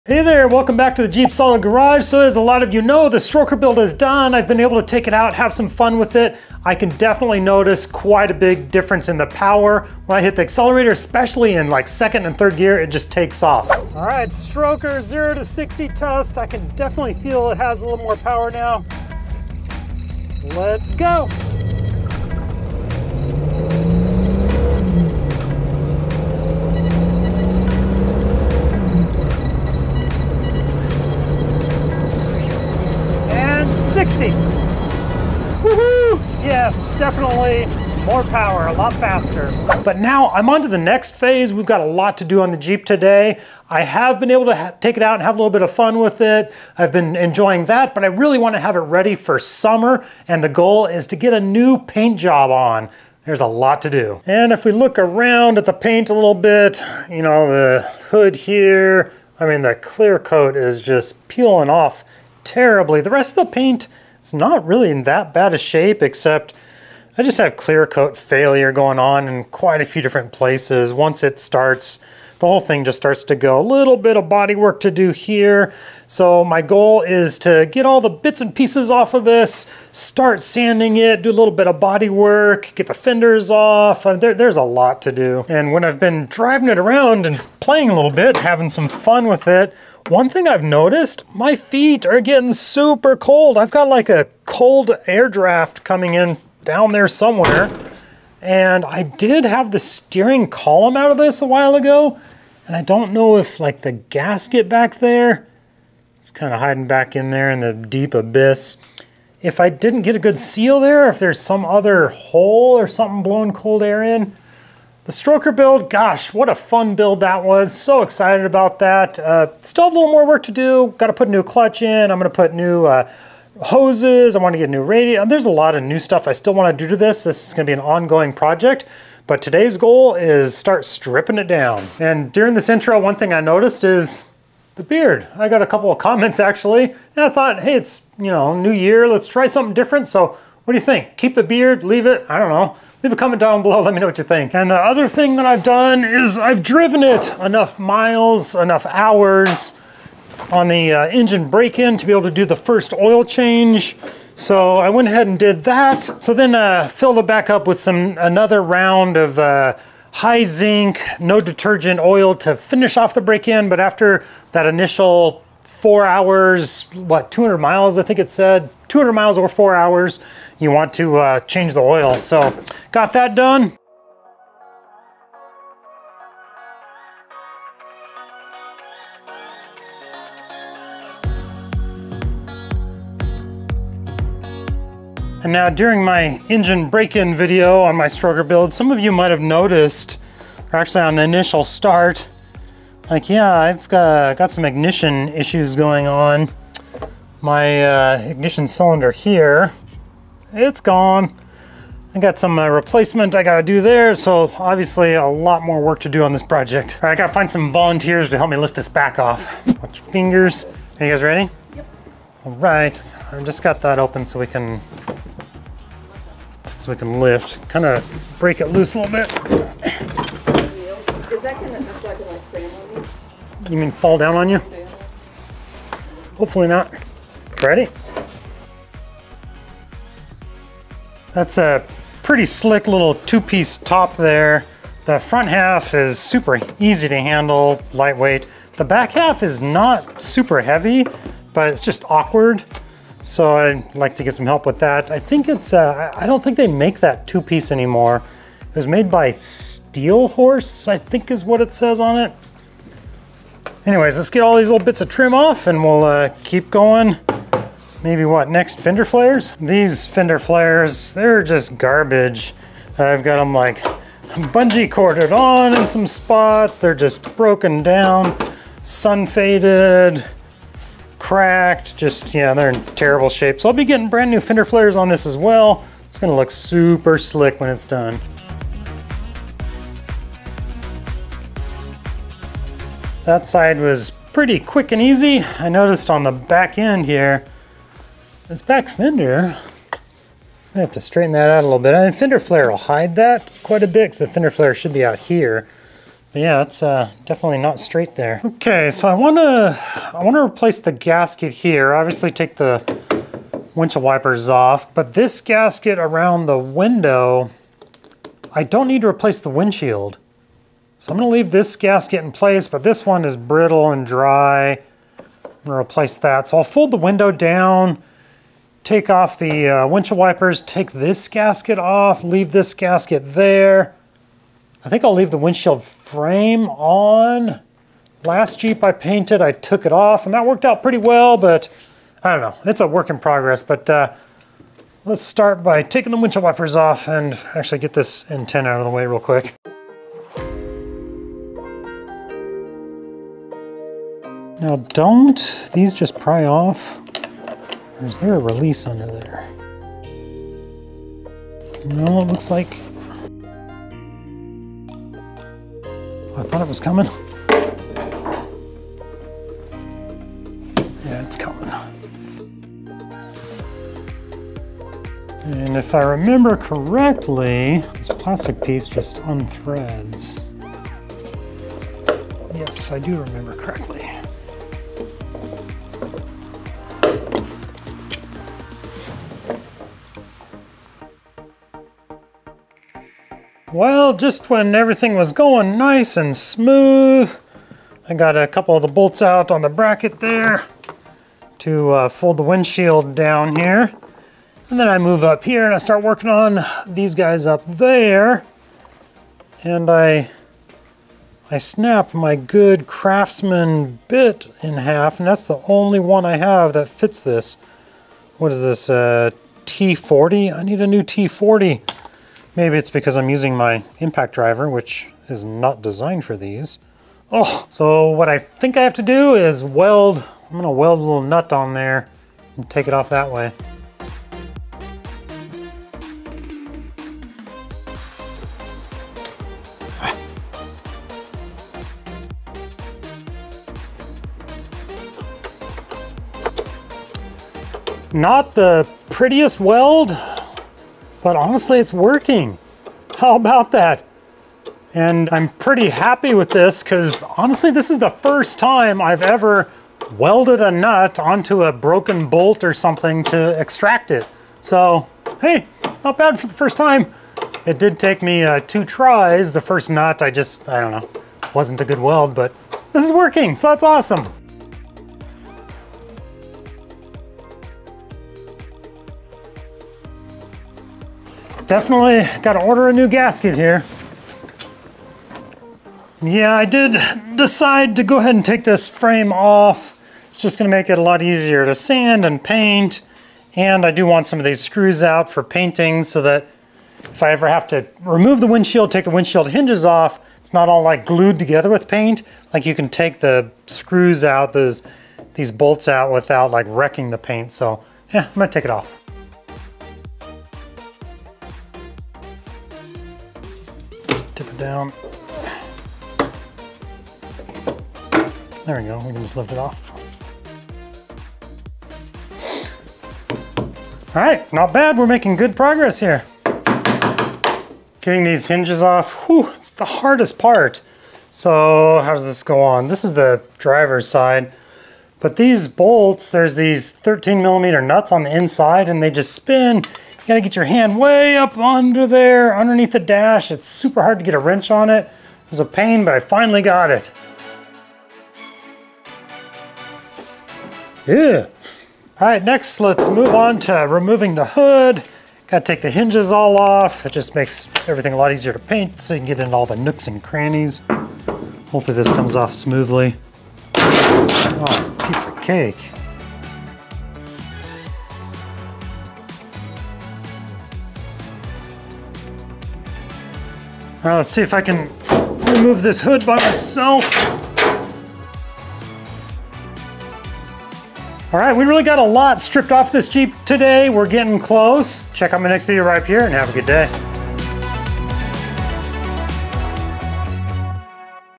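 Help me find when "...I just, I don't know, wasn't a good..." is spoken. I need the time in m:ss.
7:40.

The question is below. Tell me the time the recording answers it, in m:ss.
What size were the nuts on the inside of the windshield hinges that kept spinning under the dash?
8:46.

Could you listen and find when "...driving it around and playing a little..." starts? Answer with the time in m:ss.
1:26.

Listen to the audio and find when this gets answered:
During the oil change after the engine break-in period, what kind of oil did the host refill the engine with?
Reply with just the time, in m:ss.
2:40.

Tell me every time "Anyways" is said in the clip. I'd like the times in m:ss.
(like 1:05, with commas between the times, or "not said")
4:13.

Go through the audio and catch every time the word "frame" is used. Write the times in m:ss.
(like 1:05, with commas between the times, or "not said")
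5:25, 7:58.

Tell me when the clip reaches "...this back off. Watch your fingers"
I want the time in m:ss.
3:28.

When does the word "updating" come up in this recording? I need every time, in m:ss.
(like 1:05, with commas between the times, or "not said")
not said.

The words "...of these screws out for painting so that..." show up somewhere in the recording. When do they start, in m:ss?
8:04.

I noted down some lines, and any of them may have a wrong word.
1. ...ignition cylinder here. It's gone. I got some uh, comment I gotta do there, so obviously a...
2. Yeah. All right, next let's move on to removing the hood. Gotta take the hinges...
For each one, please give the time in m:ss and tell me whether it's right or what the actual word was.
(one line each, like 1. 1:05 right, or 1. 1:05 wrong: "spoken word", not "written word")
1. 3:18 wrong: "replacement", not "comment"
2. 9:01 right.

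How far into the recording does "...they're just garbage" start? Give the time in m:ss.
4:21.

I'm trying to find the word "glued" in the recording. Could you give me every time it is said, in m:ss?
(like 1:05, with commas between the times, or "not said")
8:11.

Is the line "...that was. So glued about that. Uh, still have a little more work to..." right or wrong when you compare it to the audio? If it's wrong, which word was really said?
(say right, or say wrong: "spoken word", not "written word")
wrong: "excited", not "glued".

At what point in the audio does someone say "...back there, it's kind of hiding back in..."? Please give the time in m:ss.
1:44.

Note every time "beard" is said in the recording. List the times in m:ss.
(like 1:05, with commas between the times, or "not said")
2:14, 2:21.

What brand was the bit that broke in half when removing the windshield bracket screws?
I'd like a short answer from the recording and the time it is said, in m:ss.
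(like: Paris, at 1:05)
Craftsman, at 6:42.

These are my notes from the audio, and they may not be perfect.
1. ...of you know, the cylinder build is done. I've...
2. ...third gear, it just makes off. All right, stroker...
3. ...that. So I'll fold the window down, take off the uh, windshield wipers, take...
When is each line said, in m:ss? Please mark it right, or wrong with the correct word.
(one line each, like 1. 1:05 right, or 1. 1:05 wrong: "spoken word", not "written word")
1. 0:02 wrong: "stroker", not "cylinder"
2. 0:12 wrong: "takes", not "makes"
3. 5:16 right.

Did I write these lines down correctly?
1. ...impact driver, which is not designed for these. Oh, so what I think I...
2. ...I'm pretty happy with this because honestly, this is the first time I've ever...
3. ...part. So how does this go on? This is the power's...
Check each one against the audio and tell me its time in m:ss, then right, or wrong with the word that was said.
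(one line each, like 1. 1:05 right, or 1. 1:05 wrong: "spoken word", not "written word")
1. 6:53 right
2. 7:25 right
3. 8:40 wrong: "driver", not "power".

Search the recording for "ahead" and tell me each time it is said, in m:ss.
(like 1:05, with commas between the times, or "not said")
2:35, 7:58.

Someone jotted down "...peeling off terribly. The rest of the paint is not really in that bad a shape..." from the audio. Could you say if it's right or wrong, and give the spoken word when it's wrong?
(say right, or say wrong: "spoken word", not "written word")
right.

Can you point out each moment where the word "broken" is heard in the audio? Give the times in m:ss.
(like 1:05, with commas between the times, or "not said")
4:27, 7:31.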